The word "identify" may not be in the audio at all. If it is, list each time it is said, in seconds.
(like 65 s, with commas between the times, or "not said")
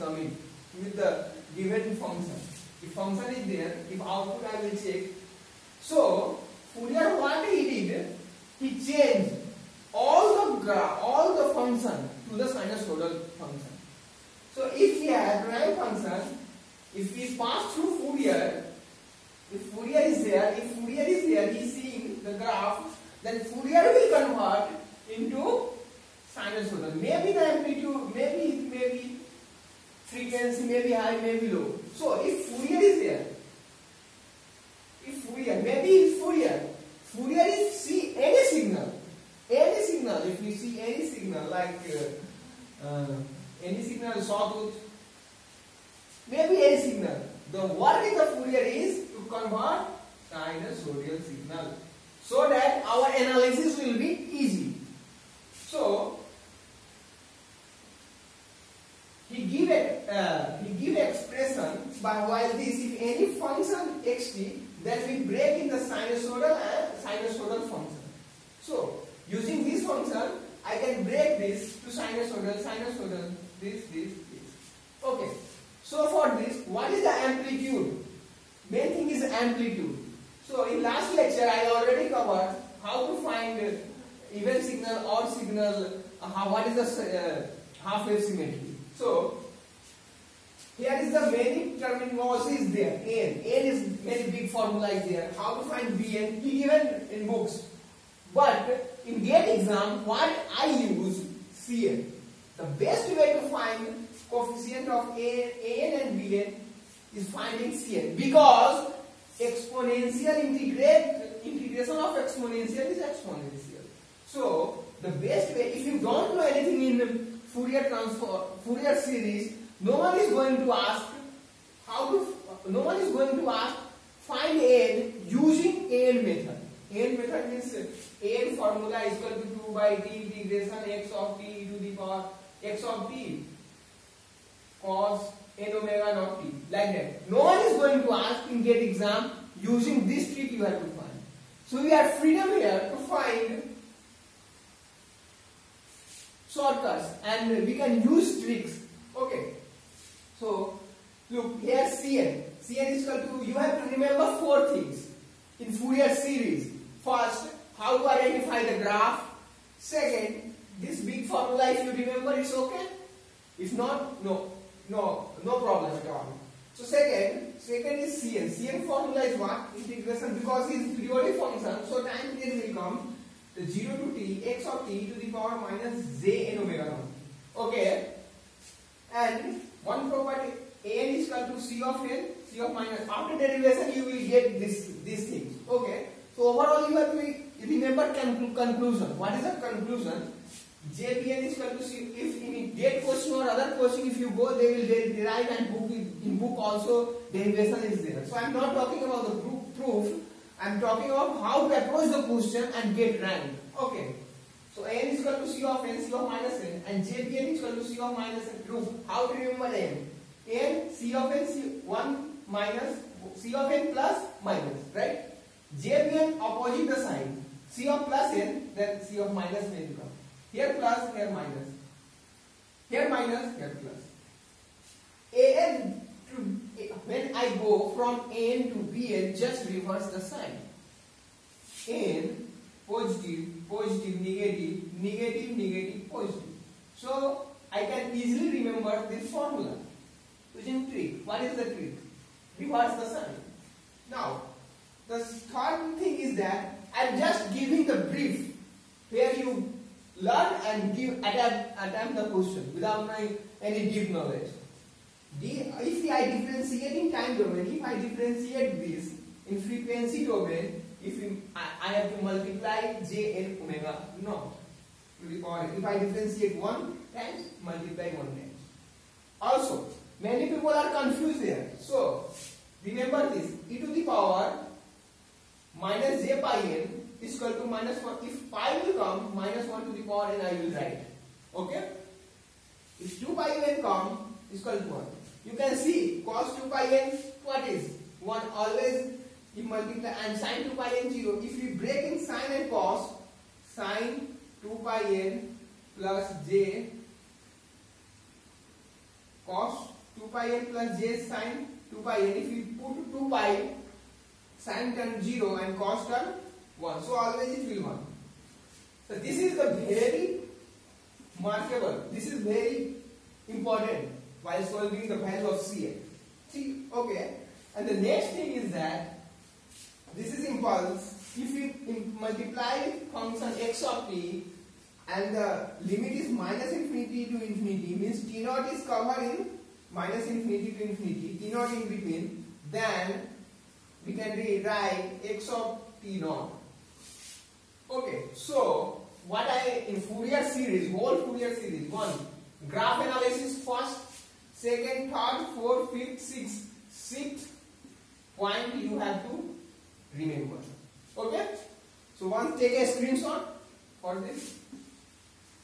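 158 s.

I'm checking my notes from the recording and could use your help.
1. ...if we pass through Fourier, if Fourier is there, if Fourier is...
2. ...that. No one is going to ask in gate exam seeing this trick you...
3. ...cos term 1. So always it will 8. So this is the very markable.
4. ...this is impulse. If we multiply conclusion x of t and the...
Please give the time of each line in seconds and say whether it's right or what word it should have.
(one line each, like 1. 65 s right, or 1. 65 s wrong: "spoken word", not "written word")
1. 16 s right
2. 136 s wrong: "using", not "seeing"
3. 305 s wrong: "1", not "8"
4. 320 s wrong: "function", not "conclusion".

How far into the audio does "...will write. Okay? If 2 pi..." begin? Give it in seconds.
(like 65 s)
280 s.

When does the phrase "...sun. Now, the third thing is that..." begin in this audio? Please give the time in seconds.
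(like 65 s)
243 s.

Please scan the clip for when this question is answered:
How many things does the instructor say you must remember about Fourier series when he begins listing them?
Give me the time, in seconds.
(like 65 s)
154 s.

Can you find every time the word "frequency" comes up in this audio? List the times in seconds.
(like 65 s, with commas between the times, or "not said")
30 s, 259 s.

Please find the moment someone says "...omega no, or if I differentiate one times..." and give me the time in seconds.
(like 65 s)
263 s.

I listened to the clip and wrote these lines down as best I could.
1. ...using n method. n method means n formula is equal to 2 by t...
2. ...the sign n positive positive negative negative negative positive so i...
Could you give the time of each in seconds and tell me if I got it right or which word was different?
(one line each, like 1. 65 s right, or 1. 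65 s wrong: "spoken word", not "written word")
1. 125 s right
2. 230 s right.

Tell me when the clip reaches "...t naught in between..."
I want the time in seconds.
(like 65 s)
331 s.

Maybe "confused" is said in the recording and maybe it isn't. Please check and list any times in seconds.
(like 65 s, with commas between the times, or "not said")
270 s.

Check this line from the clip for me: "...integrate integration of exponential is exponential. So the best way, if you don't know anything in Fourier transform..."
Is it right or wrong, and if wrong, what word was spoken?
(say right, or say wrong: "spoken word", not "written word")
right.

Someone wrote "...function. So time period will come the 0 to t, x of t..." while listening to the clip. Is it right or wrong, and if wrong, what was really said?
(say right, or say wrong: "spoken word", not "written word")
right.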